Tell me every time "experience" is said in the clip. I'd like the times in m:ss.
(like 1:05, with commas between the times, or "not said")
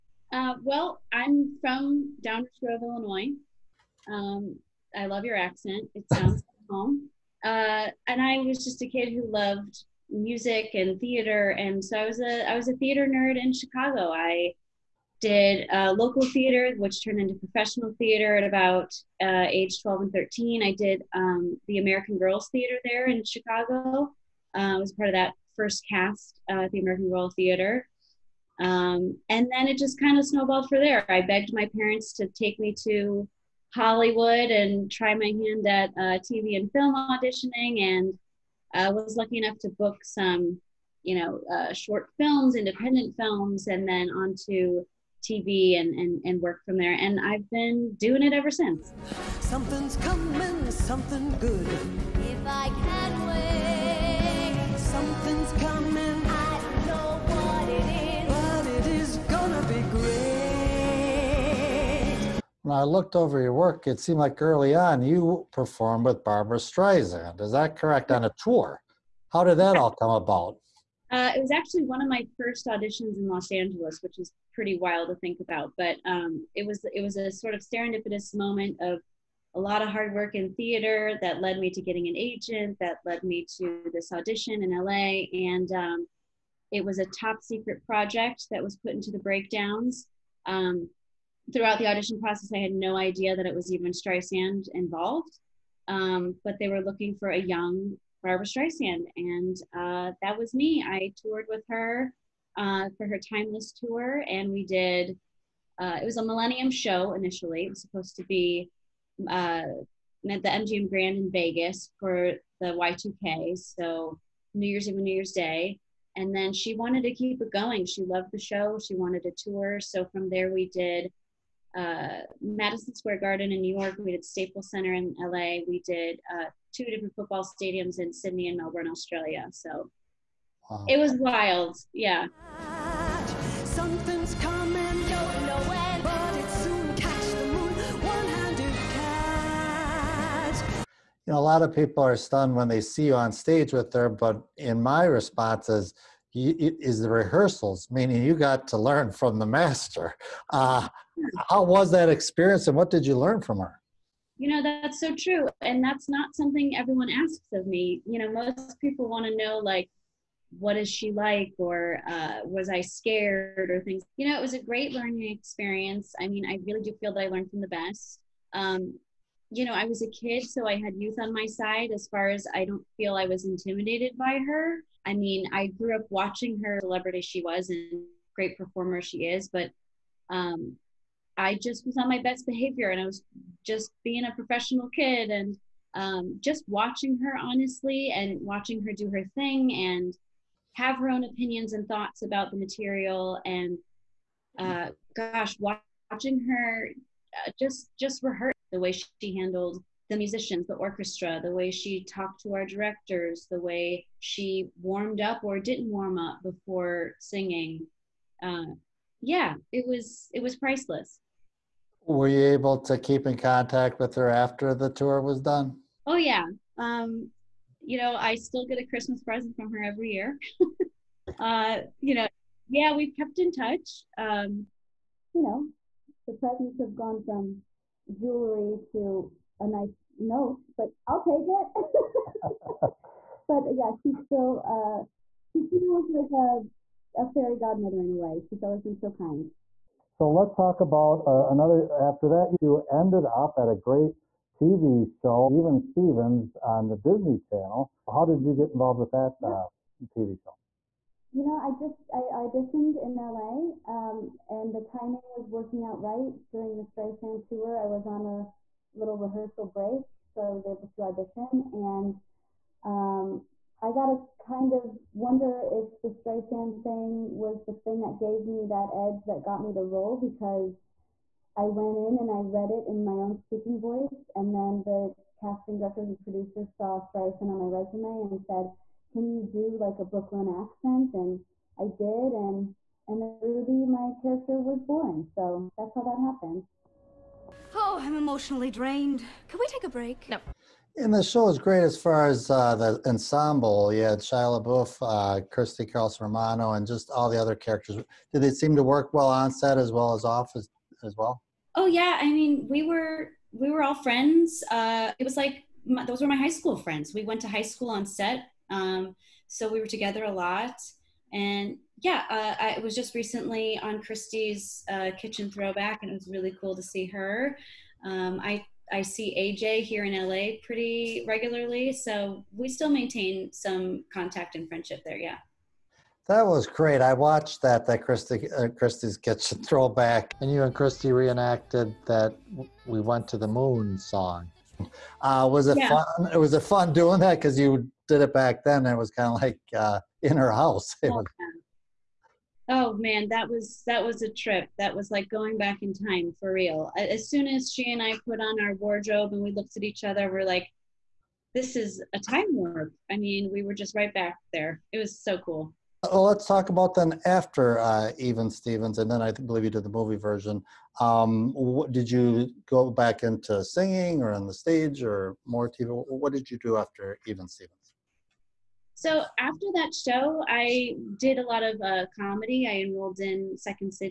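2:32, 2:45.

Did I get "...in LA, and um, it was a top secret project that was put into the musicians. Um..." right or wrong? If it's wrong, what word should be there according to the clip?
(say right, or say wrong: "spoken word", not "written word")
wrong: "breakdowns", not "musicians".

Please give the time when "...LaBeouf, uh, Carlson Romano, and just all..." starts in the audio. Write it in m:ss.
4:54.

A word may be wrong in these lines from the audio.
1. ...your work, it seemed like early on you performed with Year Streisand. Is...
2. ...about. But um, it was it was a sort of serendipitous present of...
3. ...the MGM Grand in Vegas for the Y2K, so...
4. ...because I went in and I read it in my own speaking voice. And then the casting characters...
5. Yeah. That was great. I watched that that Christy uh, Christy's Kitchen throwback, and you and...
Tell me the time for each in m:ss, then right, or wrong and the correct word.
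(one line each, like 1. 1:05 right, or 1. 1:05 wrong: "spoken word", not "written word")
1. 1:03 wrong: "Barbra", not "Year"
2. 1:15 wrong: "moment", not "present"
3. 1:50 right
4. 4:30 wrong: "directors", not "characters"
5. 5:25 right.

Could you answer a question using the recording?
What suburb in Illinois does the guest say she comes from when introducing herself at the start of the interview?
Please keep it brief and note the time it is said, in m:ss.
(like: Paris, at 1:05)
Downers Grove, at 0:02.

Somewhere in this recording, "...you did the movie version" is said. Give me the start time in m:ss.
5:59.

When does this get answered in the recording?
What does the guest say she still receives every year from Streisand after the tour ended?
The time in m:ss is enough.
3:38.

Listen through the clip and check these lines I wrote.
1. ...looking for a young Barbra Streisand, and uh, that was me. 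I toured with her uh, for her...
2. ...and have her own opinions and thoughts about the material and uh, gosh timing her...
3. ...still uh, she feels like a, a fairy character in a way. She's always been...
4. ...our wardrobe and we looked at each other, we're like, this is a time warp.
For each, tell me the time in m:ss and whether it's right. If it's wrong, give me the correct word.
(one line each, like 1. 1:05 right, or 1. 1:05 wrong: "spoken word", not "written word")
1. 1:36 right
2. 3:09 wrong: "watching", not "timing"
3. 3:54 wrong: "godmother", not "character"
4. 5:48 right.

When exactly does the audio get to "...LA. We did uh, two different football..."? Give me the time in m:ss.
2:05.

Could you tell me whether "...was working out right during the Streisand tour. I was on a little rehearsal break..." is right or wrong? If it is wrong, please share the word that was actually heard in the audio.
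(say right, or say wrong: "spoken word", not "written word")
right.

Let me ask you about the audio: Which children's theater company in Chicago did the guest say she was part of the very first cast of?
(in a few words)
American Girl Theater.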